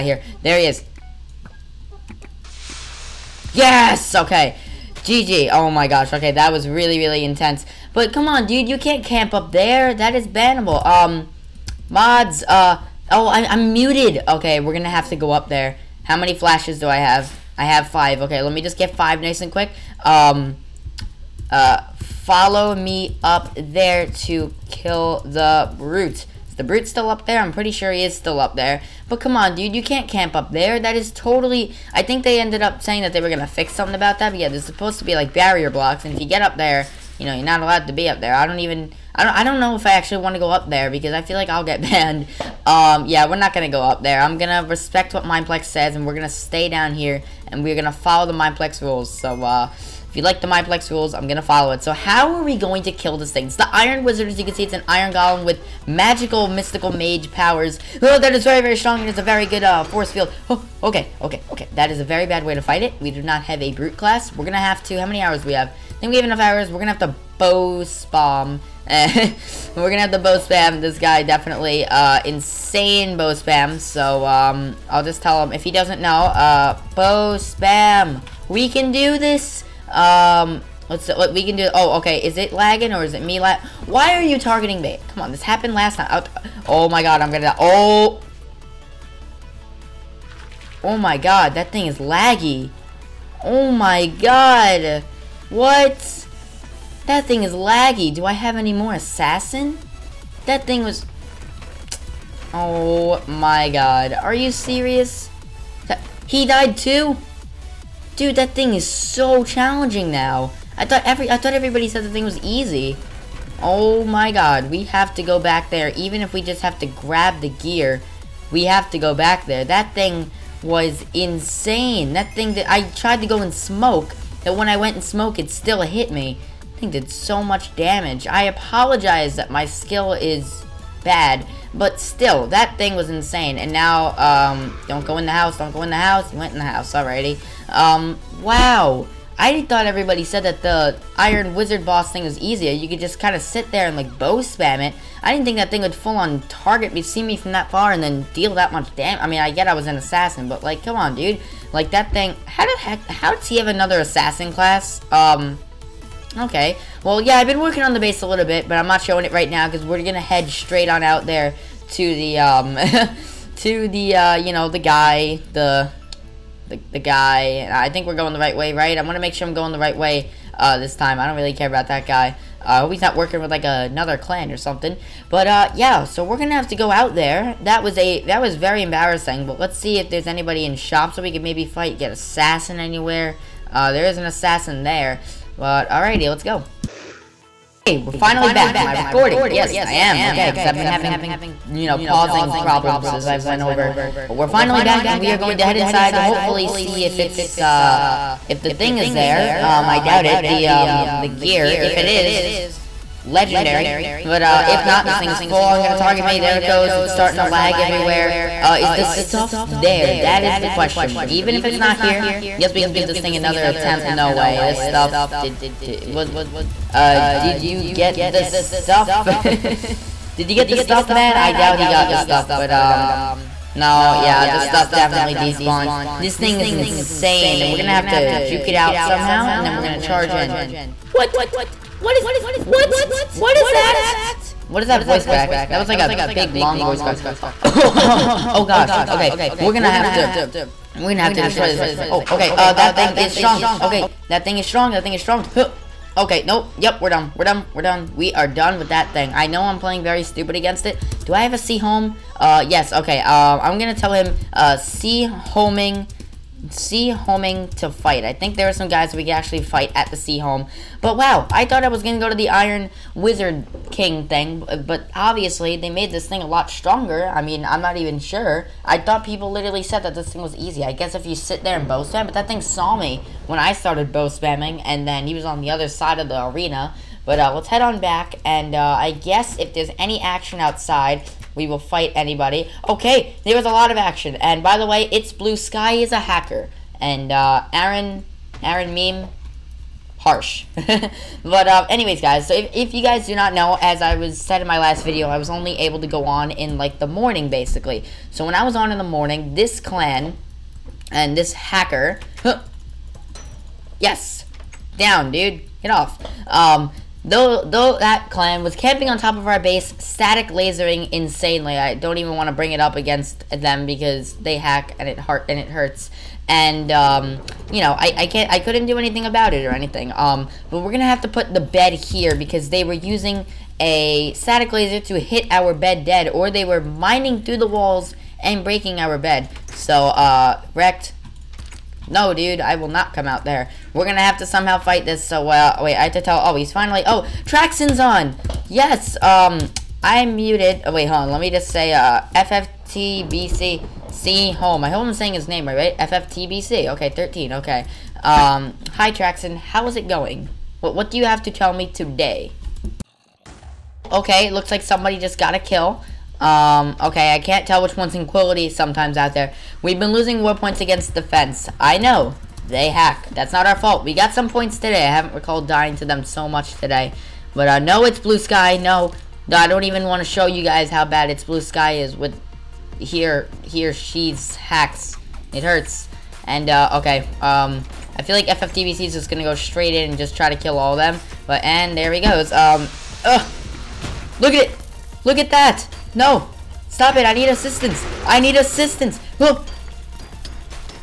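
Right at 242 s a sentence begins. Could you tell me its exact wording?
Oh, okay, uh, that thing is strong.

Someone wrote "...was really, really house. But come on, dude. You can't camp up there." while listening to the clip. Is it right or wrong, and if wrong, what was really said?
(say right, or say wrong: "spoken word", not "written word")
wrong: "intense", not "house".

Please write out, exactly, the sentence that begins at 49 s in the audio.
So, uh, you like the Mineplex rules, I'm gonna follow it.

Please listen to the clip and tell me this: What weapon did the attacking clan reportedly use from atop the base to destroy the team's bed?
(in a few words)
static laser.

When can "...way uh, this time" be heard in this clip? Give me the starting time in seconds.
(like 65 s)
169 s.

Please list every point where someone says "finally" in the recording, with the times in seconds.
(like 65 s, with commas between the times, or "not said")
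188 s, 194 s, 336 s.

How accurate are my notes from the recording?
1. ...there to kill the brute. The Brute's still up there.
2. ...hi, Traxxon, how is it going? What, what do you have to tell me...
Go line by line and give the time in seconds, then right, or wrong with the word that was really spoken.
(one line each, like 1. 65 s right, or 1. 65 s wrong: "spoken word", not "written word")
1. 23 s right
2. 348 s right.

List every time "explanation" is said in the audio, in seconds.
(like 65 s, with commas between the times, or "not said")
not said.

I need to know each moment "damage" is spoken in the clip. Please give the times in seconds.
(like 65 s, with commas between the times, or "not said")
127 s, 148 s.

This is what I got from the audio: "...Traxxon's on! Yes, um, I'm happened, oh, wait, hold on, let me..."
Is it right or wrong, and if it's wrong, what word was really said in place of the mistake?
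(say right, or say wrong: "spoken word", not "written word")
wrong: "muted", not "happened".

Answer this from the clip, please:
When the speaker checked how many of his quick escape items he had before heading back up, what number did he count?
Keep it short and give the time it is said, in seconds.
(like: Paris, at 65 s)
5, at 17 s.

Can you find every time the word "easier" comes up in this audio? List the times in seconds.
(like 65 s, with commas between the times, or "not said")
142 s.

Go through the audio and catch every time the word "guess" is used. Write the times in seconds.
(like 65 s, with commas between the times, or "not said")
212 s, 270 s, 279 s.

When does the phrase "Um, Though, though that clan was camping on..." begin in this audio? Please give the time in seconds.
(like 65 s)
306 s.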